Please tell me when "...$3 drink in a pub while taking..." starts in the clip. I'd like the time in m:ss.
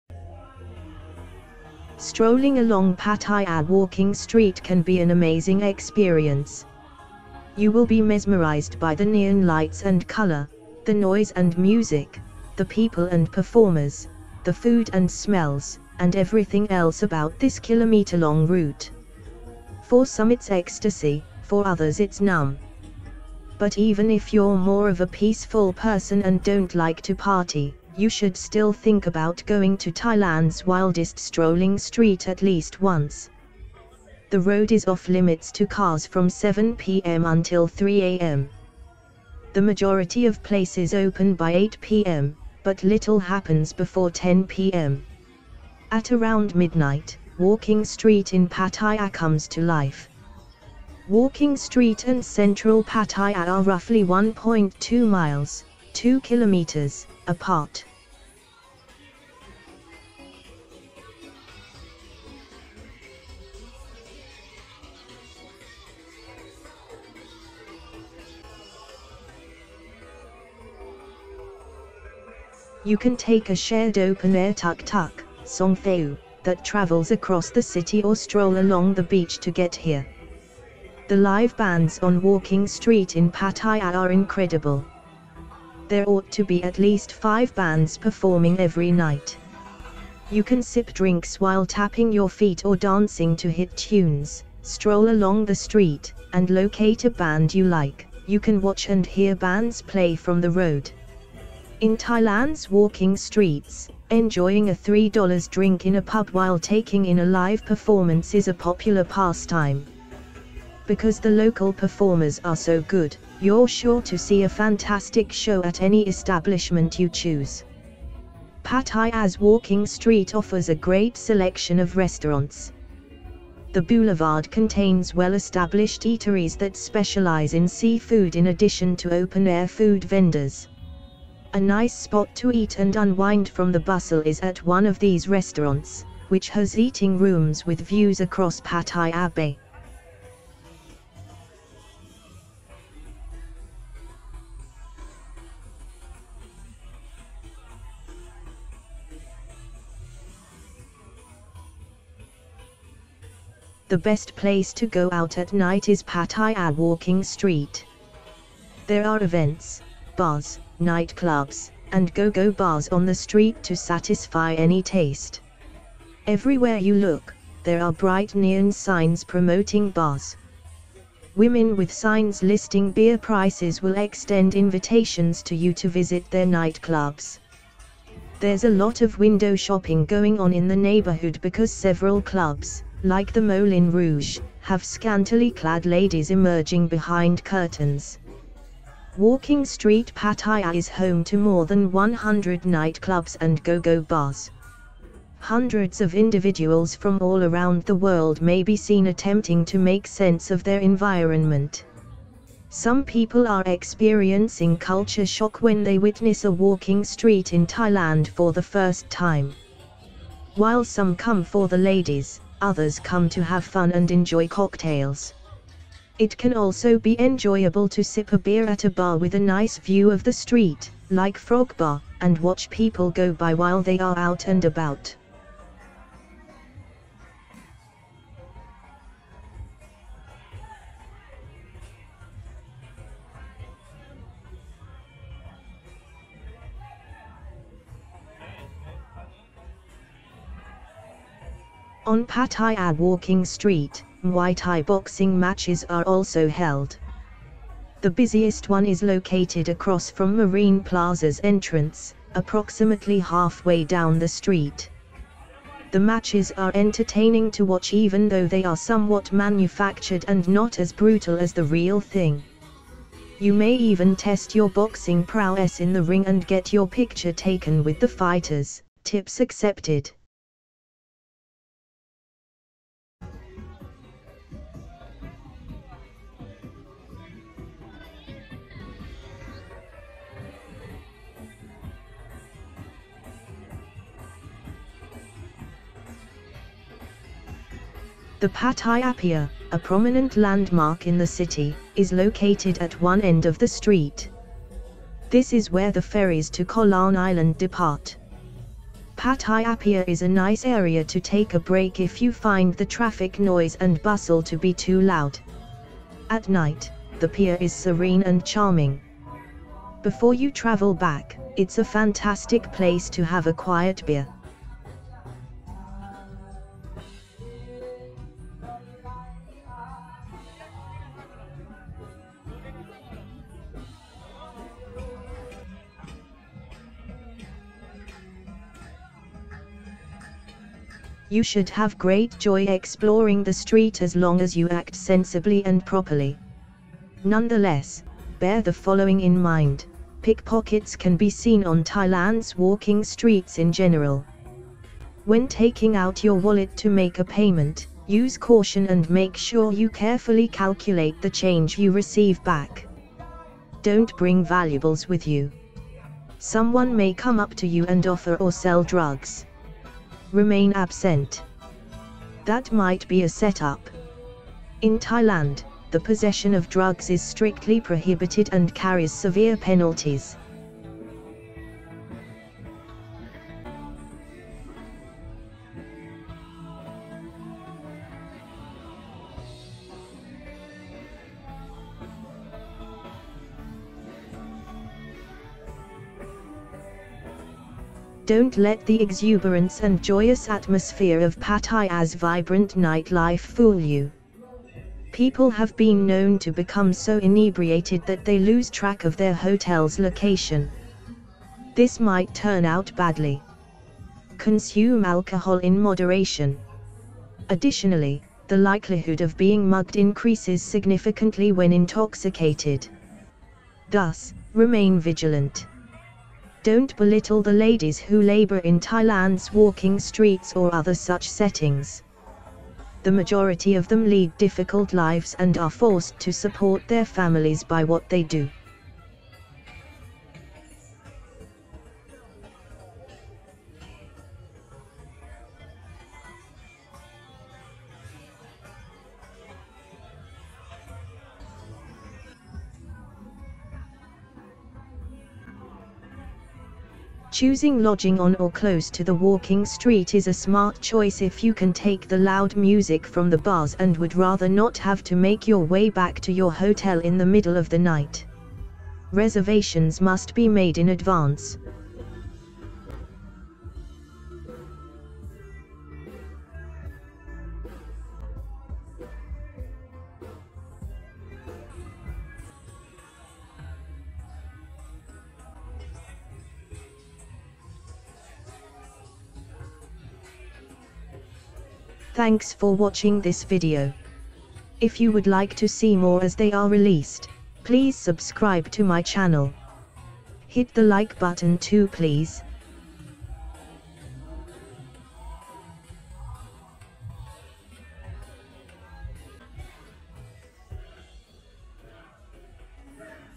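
1:45.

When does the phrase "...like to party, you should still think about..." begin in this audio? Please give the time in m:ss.
0:26.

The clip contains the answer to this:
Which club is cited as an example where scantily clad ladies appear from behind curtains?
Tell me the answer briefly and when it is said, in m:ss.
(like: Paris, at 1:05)
Moulin Rouge, at 3:03.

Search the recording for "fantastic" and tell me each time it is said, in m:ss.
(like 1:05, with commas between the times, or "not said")
1:54, 5:11.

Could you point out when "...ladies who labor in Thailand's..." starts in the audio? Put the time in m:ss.
6:57.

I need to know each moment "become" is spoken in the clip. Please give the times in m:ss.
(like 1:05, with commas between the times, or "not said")
6:36.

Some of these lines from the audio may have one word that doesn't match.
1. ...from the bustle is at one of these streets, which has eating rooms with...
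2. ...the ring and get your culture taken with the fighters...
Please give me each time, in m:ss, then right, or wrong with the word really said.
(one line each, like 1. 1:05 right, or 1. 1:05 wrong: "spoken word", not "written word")
1. 2:13 wrong: "restaurants", not "streets"
2. 4:25 wrong: "picture", not "culture".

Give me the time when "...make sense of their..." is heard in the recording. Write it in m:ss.
3:19.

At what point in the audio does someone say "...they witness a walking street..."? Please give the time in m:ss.
3:25.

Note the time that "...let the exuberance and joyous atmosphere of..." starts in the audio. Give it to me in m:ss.
6:28.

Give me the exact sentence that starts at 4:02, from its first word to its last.
On Pattaya Walking Street, Muay Thai boxing matches are also held.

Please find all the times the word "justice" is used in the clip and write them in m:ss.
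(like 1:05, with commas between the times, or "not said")
not said.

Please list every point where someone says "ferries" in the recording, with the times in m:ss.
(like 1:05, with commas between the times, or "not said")
4:56.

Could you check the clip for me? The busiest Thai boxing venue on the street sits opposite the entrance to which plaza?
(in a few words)
Marine Plaza.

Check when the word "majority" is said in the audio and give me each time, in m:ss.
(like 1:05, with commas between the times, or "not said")
0:39, 7:03.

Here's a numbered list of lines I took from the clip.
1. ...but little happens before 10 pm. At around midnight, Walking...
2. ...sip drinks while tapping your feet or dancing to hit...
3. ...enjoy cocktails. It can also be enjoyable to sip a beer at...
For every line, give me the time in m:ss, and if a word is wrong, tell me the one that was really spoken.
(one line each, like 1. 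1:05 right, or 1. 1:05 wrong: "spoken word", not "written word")
1. 0:42 right
2. 1:30 right
3. 3:34 right.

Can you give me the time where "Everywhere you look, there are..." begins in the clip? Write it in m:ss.
2:46.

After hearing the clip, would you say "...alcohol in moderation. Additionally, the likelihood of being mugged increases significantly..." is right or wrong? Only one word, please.
right.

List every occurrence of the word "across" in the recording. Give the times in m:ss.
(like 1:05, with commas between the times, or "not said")
1:17, 2:18, 4:09.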